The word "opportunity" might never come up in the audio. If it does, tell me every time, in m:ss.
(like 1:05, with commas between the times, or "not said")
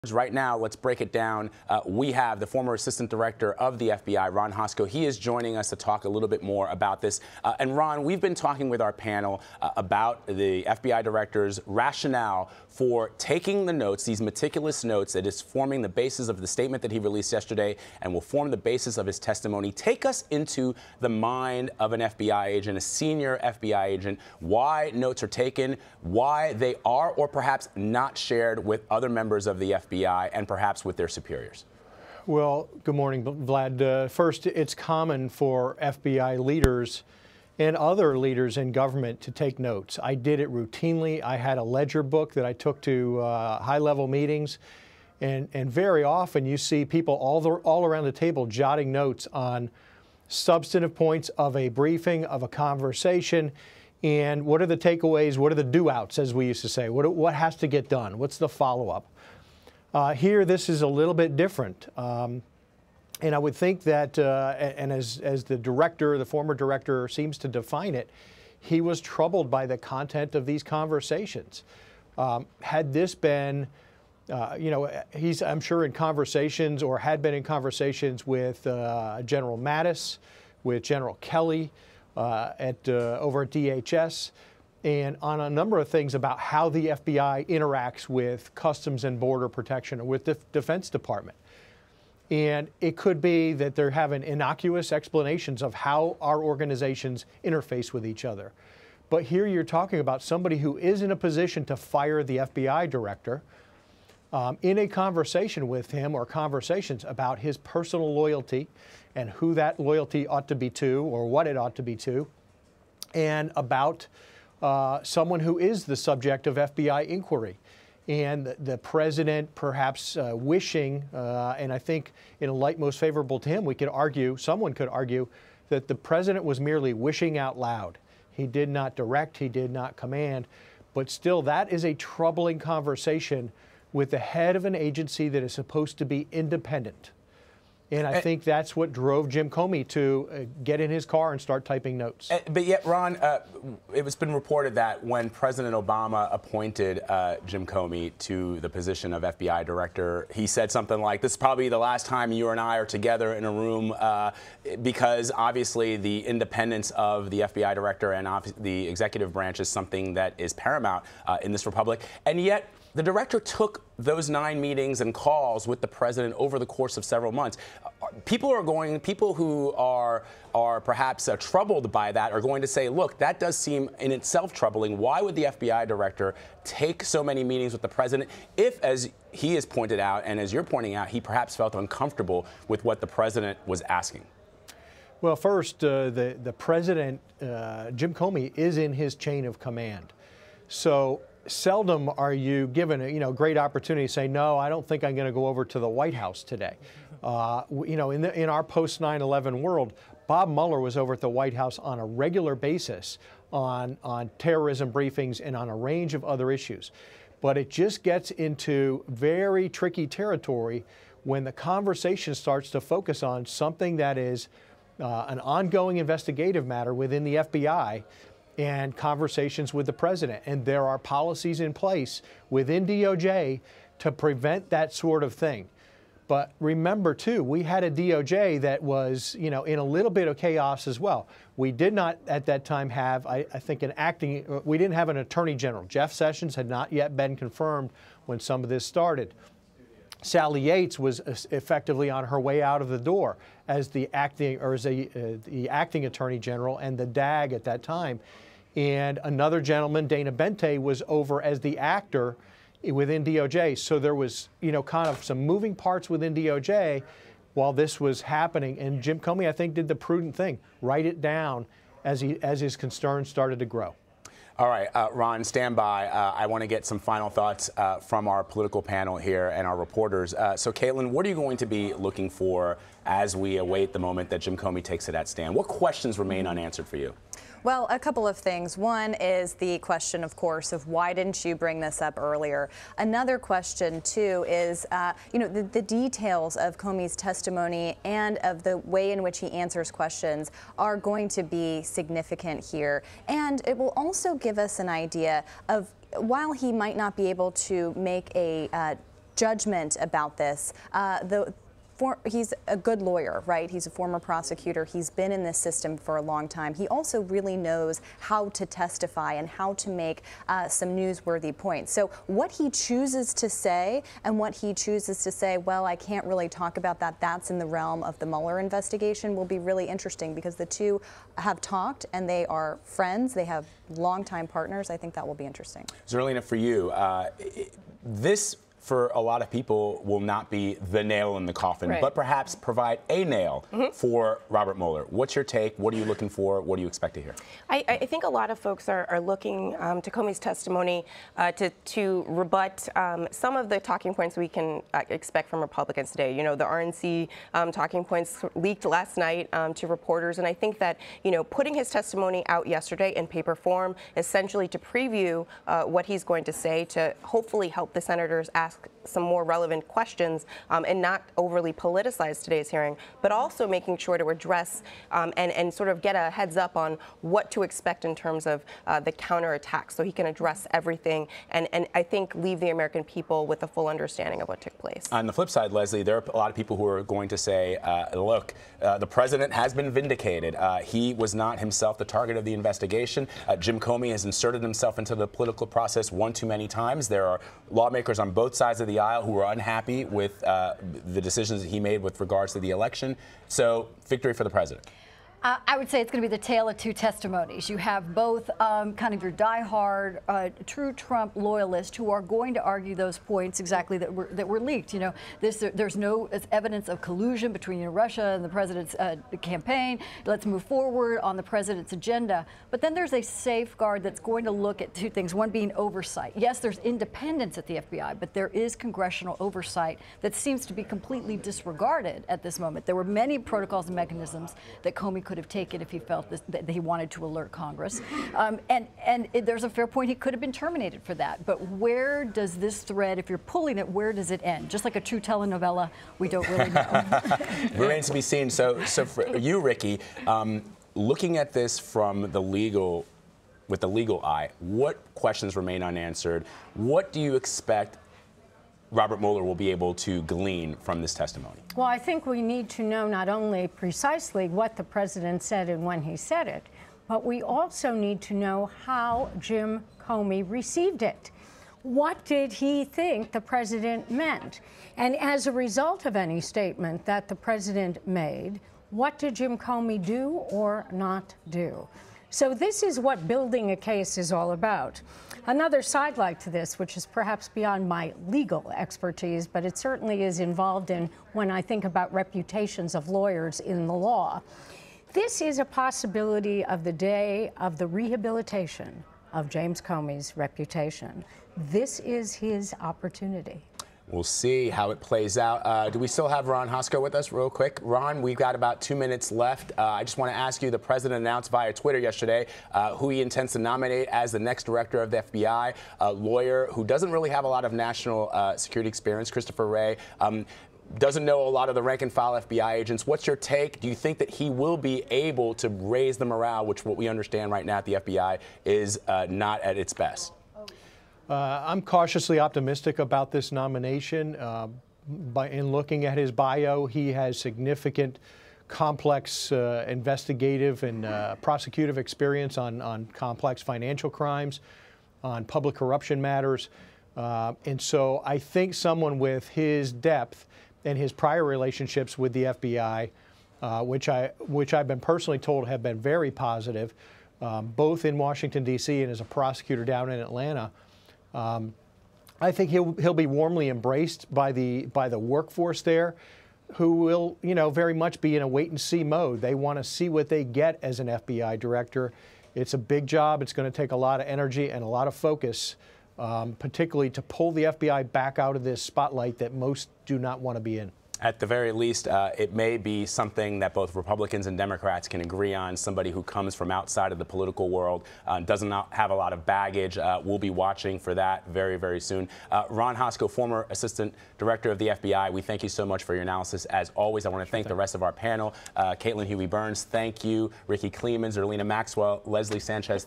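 3:13, 8:12.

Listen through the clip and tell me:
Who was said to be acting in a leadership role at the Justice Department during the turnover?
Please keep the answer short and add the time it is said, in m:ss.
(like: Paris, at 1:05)
Dana Boente, at 4:10.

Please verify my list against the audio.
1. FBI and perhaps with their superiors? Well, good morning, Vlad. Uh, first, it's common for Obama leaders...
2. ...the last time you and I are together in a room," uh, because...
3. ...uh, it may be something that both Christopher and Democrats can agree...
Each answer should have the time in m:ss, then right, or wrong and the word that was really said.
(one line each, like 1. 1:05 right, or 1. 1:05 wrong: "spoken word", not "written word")
1. 0:29 wrong: "FBI", not "Obama"
2. 2:31 right
3. 9:32 wrong: "Republicans", not "Christopher".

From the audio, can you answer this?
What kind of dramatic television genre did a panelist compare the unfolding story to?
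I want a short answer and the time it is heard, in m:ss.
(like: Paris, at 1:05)
telenovela, at 7:15.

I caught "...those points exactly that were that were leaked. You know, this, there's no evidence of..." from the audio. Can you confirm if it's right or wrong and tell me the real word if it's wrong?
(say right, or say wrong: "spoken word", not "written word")
right.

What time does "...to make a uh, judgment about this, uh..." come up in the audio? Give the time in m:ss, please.
4:57.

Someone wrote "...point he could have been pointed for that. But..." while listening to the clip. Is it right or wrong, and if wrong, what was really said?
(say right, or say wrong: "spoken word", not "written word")
wrong: "terminated", not "pointed".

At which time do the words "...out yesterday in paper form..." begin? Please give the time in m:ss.
5:52.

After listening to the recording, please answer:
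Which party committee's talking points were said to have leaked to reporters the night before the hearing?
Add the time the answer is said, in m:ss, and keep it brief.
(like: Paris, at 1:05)
RNC, at 5:46.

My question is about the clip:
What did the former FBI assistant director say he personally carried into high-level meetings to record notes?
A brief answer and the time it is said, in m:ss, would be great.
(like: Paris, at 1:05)
a ledger book, at 0:41.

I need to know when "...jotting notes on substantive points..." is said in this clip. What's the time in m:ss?
0:48.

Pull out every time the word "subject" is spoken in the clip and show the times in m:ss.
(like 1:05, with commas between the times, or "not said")
1:55.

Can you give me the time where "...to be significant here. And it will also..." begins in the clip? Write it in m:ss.
4:51.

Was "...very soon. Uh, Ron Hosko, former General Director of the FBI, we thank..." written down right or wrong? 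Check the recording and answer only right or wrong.
wrong.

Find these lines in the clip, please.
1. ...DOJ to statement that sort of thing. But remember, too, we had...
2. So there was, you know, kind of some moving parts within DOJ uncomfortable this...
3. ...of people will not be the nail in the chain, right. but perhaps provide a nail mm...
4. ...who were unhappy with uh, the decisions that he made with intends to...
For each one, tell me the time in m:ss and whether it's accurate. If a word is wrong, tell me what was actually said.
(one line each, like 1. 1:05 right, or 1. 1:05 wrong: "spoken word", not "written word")
1. 3:42 wrong: "prevent", not "statement"
2. 4:13 wrong: "while", not "uncomfortable"
3. 5:29 wrong: "coffin", not "chain"
4. 6:29 wrong: "regards", not "intends".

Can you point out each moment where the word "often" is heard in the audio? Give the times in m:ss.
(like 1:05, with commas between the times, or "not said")
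0:46.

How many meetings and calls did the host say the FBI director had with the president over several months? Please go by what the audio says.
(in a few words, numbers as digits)
9.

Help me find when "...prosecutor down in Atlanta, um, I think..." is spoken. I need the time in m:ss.
9:09.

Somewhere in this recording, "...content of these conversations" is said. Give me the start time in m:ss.
1:09.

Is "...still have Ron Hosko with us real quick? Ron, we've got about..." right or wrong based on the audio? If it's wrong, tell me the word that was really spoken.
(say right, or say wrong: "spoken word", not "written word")
right.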